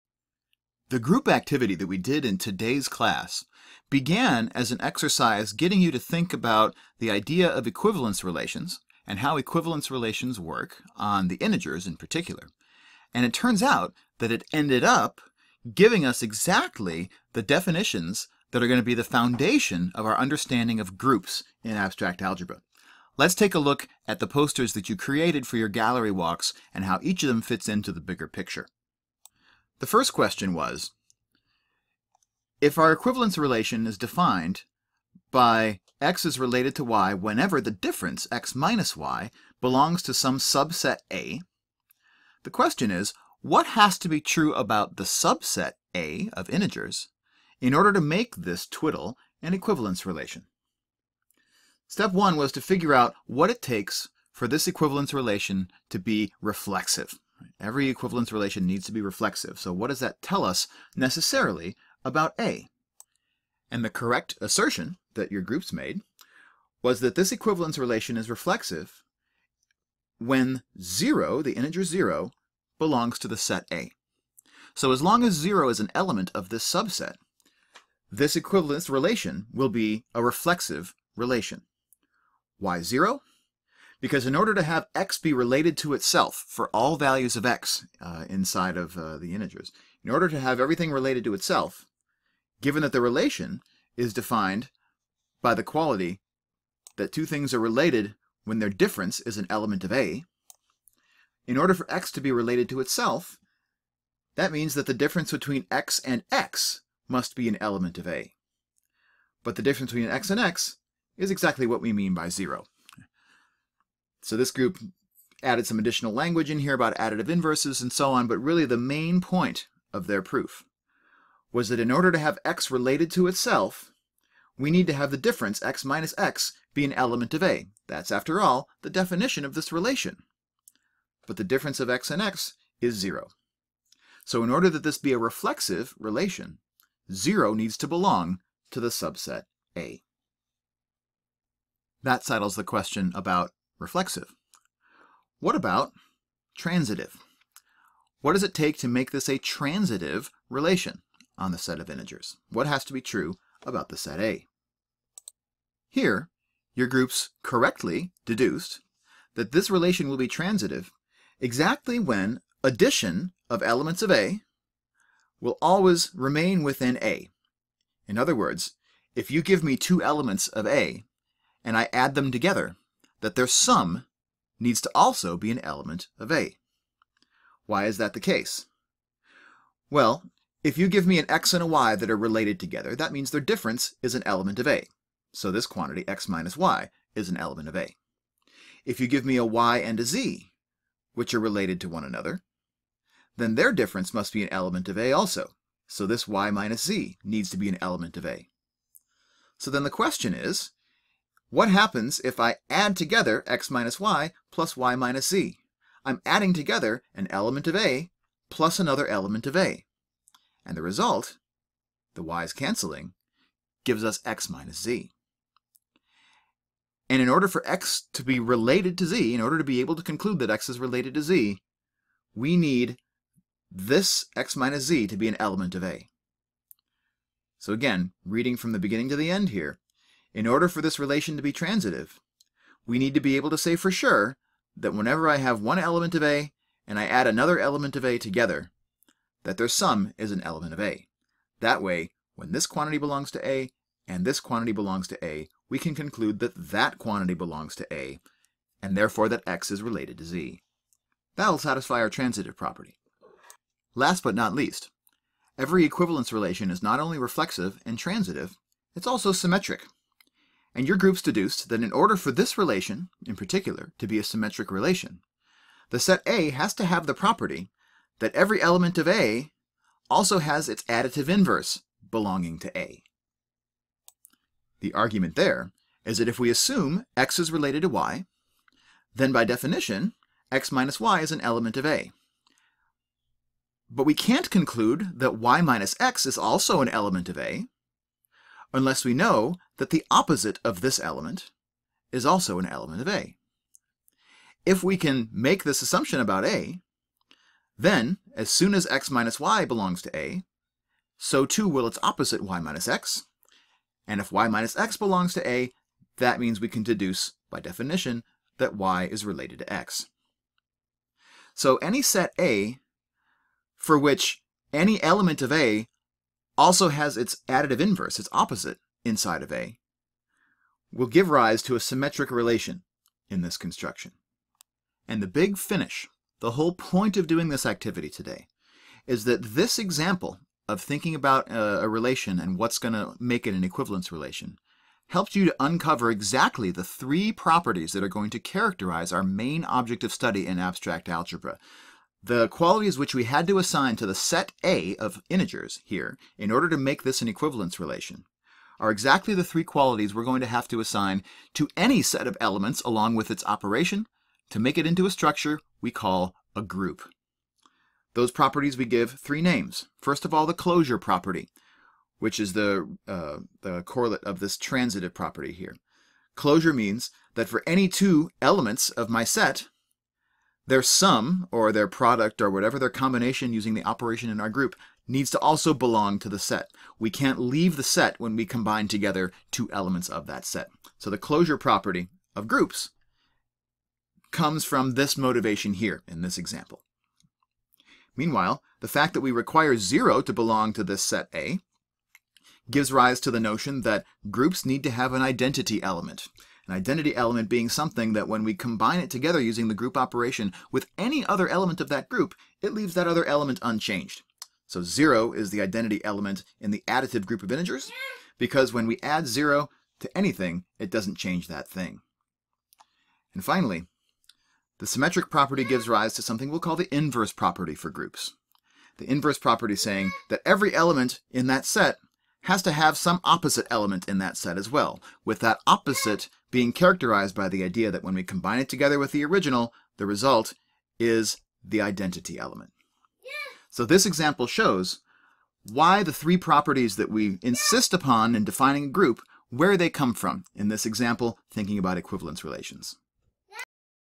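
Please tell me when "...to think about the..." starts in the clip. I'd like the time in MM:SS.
00:05.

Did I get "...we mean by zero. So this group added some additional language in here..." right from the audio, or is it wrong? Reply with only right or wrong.
right.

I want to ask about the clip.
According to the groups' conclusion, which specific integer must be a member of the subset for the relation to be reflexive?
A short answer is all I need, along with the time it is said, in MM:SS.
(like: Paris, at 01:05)
0, at 01:11.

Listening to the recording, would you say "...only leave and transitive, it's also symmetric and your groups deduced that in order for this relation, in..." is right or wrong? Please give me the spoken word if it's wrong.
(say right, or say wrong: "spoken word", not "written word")
wrong: "reflexive", not "leave".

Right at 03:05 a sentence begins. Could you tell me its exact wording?
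So this quantity, x minus y, is an element of A.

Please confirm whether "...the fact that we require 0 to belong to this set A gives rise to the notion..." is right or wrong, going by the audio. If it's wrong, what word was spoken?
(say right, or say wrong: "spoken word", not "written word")
right.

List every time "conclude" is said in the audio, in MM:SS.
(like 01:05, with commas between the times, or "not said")
03:40, 04:05, 04:44.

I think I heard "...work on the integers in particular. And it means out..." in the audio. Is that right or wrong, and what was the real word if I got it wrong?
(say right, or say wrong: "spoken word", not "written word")
wrong: "turns", not "means".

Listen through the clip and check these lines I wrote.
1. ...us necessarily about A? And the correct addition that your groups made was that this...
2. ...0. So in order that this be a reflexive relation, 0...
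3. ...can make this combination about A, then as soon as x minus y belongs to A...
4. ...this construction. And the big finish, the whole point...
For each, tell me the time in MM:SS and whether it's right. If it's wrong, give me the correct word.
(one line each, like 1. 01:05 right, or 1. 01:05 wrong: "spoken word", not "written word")
1. 01:00 wrong: "assertion", not "addition"
2. 02:12 right
3. 04:54 wrong: "assumption", not "combination"
4. 05:23 right.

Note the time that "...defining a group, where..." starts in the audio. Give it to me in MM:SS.
07:18.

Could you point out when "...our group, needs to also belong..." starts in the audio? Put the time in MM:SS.
06:14.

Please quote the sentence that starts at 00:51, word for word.
Step one was to figure out what it takes for this equivalence relation to be reflexive.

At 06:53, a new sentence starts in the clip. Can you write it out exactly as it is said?
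And finally, the symmetric property gives rise to something we'll call the inverse property for groups.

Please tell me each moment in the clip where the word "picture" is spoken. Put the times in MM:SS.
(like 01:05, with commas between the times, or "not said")
00:28.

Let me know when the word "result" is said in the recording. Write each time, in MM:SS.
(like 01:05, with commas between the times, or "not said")
03:30, 07:10.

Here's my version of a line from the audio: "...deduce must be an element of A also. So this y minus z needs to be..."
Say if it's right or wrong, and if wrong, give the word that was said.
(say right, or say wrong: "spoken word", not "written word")
wrong: "difference", not "deduce".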